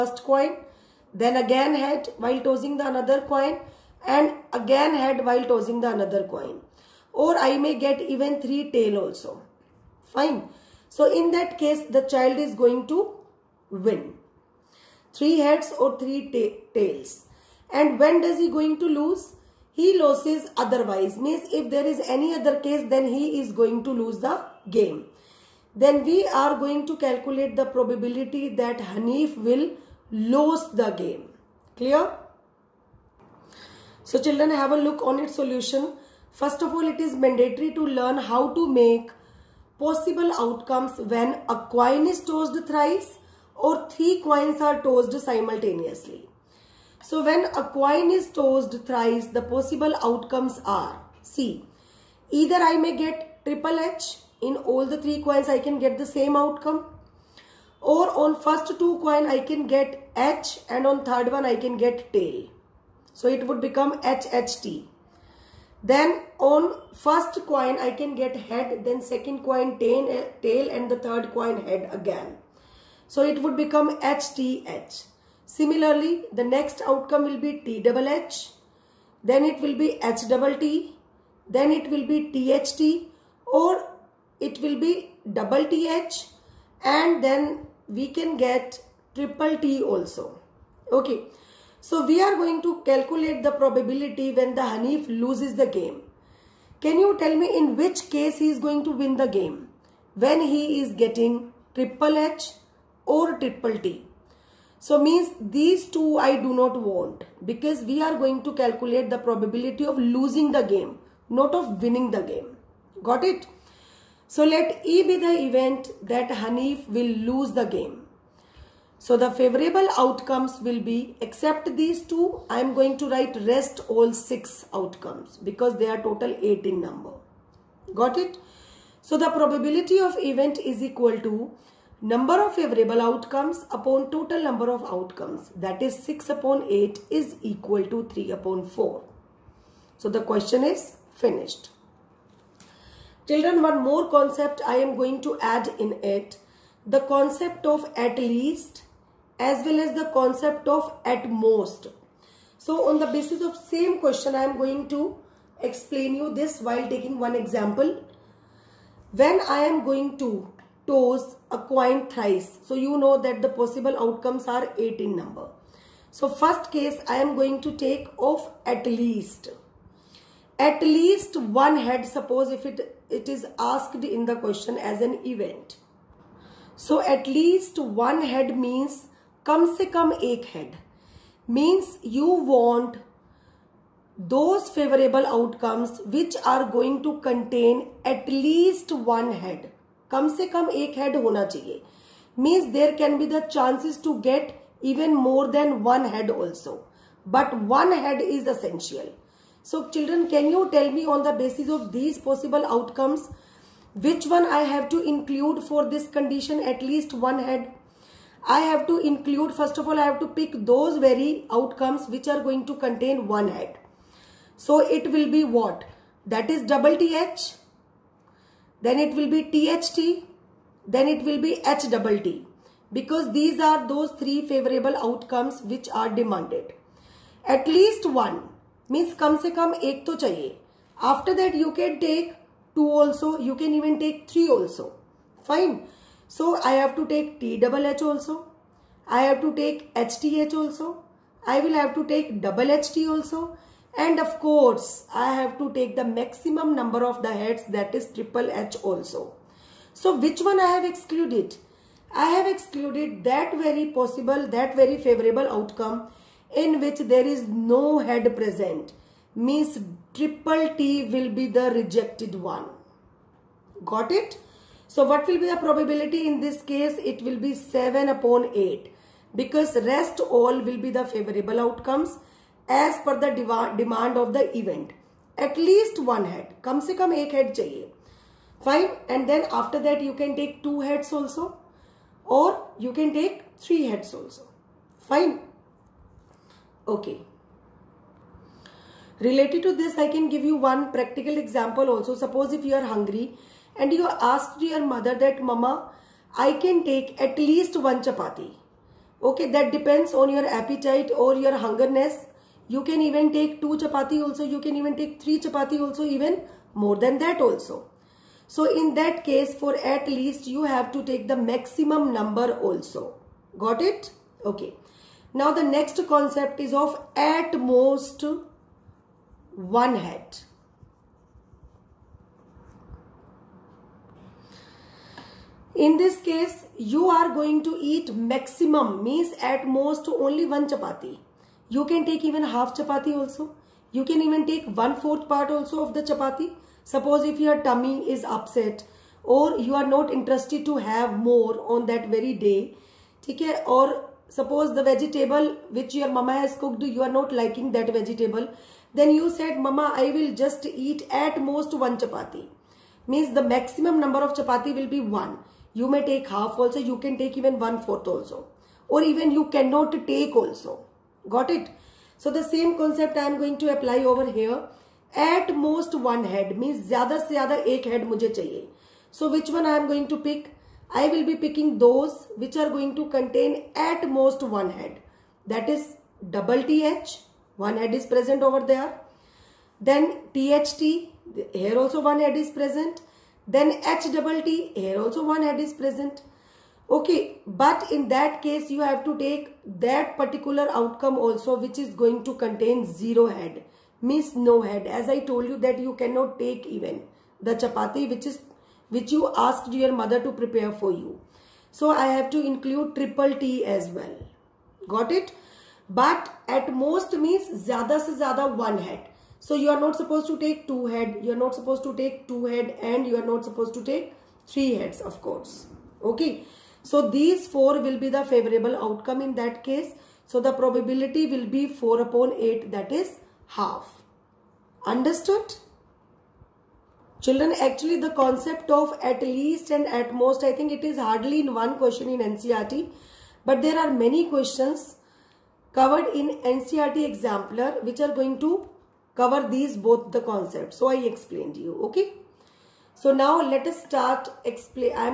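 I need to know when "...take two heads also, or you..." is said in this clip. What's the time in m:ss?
4:40.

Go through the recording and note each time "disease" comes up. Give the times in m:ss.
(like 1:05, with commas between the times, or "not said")
not said.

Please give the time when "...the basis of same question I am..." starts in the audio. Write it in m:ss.
2:33.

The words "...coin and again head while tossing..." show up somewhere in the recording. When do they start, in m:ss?
0:03.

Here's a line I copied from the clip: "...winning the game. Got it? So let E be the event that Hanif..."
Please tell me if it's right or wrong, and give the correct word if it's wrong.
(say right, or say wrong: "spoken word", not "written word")
right.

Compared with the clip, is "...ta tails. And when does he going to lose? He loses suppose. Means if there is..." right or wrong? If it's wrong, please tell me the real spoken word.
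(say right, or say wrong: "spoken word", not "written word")
wrong: "otherwise", not "suppose".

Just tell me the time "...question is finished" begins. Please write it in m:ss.
2:20.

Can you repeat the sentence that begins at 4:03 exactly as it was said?
And of course, I have to take the maximum number of the heads that is triple H also.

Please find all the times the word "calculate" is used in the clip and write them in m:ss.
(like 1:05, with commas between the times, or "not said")
0:26, 1:32, 1:48.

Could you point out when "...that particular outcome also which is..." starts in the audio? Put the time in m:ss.
6:29.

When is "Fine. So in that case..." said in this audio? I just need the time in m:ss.
0:10.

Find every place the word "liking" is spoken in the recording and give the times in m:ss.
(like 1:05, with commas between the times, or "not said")
5:47.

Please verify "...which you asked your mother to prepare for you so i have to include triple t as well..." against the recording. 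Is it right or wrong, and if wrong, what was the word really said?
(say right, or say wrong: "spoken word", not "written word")
right.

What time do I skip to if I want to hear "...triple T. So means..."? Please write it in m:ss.
1:43.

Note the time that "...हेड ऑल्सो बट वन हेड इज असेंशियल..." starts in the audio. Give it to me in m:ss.
3:16.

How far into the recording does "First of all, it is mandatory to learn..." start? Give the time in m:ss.
0:36.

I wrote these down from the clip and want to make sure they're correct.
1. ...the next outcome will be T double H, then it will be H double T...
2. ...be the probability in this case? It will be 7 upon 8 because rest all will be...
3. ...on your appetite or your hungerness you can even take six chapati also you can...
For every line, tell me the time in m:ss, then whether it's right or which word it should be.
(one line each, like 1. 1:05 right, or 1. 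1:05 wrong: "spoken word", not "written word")
1. 1:16 right
2. 4:25 right
3. 5:00 wrong: "two", not "six".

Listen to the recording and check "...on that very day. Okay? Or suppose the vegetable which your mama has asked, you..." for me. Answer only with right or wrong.
wrong.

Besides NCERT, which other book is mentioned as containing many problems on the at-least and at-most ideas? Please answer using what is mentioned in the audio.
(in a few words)
NCERT exemplar.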